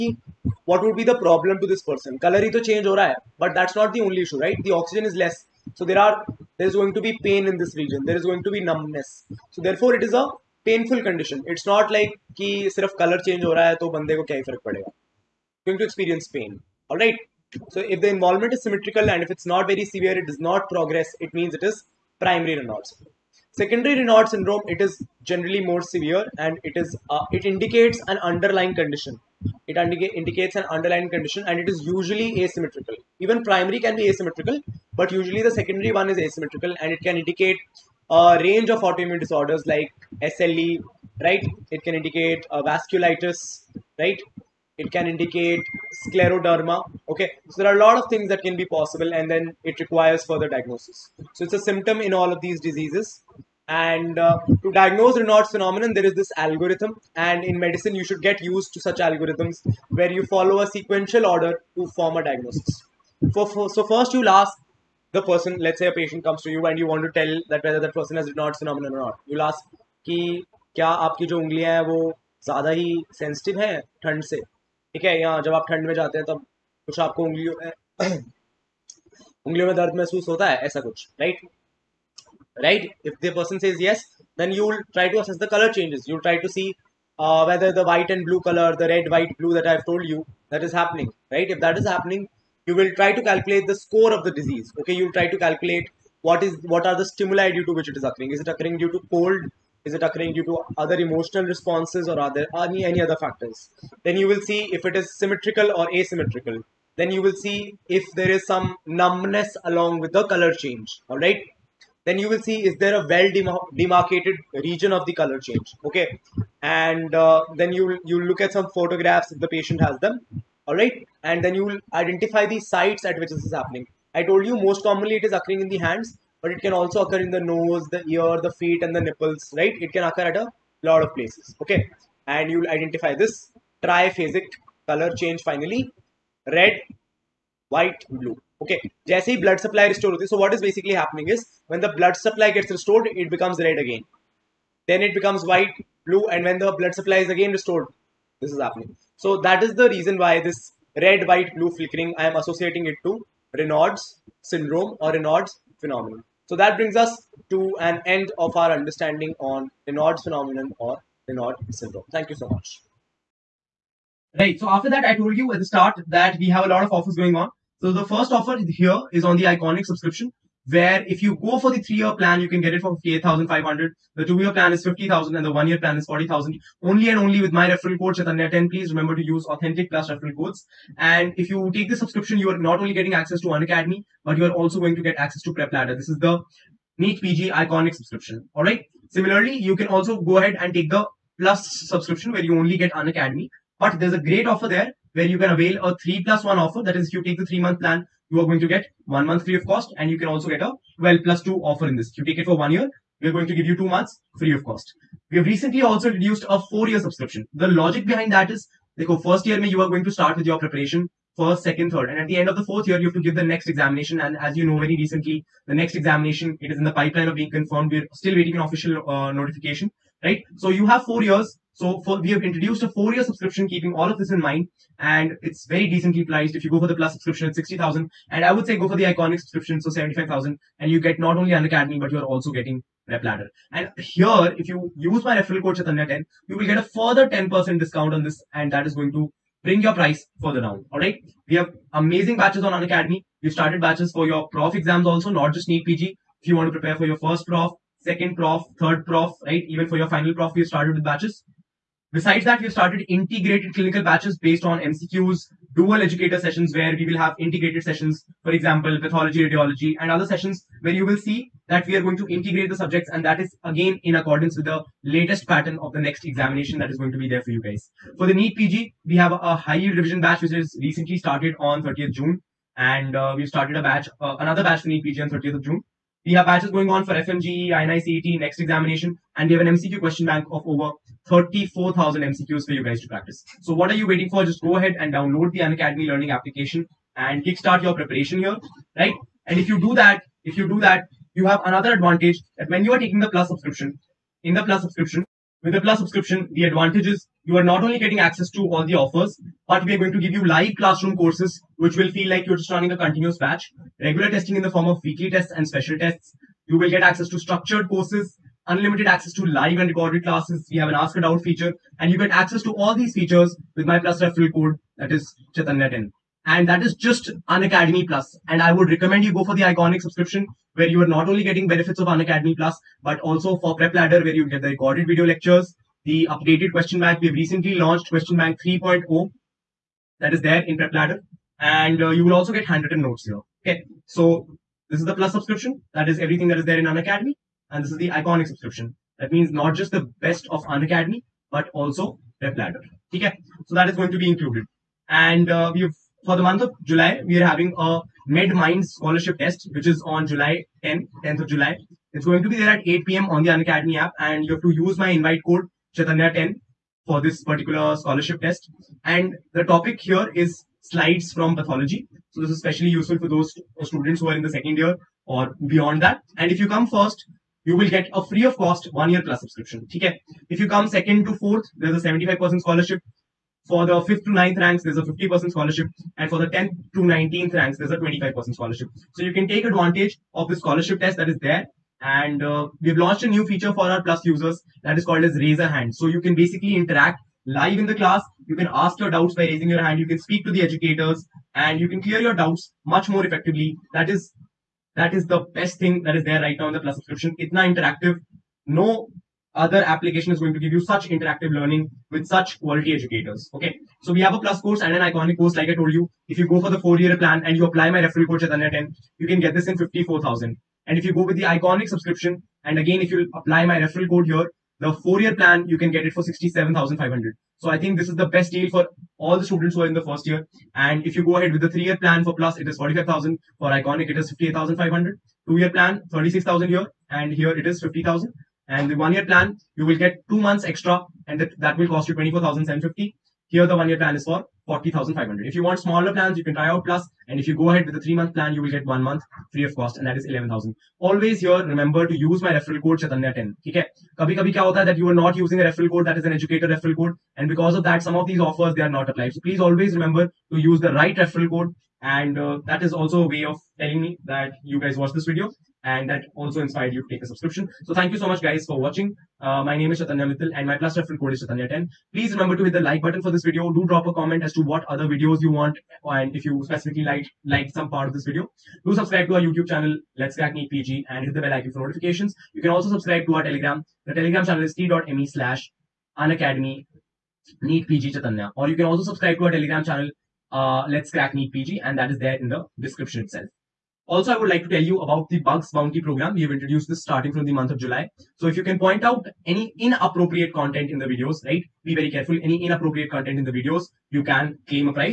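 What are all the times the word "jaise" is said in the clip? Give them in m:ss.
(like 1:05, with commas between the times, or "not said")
2:19.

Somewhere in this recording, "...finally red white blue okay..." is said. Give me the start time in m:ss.
2:15.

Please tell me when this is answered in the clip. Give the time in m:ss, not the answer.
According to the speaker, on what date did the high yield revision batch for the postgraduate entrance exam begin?
4:31.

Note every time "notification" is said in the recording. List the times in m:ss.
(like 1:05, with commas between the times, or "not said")
3:39, 7:51.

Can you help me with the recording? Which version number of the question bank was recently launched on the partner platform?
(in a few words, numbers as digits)
3.0.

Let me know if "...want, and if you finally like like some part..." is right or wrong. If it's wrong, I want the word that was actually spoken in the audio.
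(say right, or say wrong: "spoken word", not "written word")
wrong: "specifically", not "finally".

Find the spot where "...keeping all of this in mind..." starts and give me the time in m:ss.
3:43.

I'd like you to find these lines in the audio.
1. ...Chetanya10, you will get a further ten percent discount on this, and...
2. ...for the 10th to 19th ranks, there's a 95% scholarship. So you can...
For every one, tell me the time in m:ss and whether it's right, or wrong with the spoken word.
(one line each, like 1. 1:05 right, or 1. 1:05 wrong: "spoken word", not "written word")
1. 3:55 right
2. 6:16 wrong: "25", not "95".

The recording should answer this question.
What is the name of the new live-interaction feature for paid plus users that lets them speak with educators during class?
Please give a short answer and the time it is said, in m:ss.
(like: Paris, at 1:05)
raise a hand, at 6:25.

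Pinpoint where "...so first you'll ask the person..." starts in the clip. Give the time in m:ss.
1:03.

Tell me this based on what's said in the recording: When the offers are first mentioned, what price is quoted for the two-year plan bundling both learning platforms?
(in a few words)
50,000.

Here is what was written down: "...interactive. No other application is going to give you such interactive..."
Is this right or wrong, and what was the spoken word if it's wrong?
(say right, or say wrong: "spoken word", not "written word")
right.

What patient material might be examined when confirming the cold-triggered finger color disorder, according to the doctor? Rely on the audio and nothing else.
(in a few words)
photographs.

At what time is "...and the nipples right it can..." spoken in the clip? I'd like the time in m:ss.
2:08.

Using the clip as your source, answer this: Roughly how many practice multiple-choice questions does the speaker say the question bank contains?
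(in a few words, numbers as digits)
34,000.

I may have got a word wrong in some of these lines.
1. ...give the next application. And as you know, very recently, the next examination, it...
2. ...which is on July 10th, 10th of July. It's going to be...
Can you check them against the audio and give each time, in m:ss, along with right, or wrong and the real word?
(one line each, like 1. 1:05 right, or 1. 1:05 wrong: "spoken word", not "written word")
1. 3:33 wrong: "examination", not "application"
2. 5:49 right.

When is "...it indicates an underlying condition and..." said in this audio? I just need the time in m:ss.
0:29.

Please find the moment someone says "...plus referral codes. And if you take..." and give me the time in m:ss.
2:59.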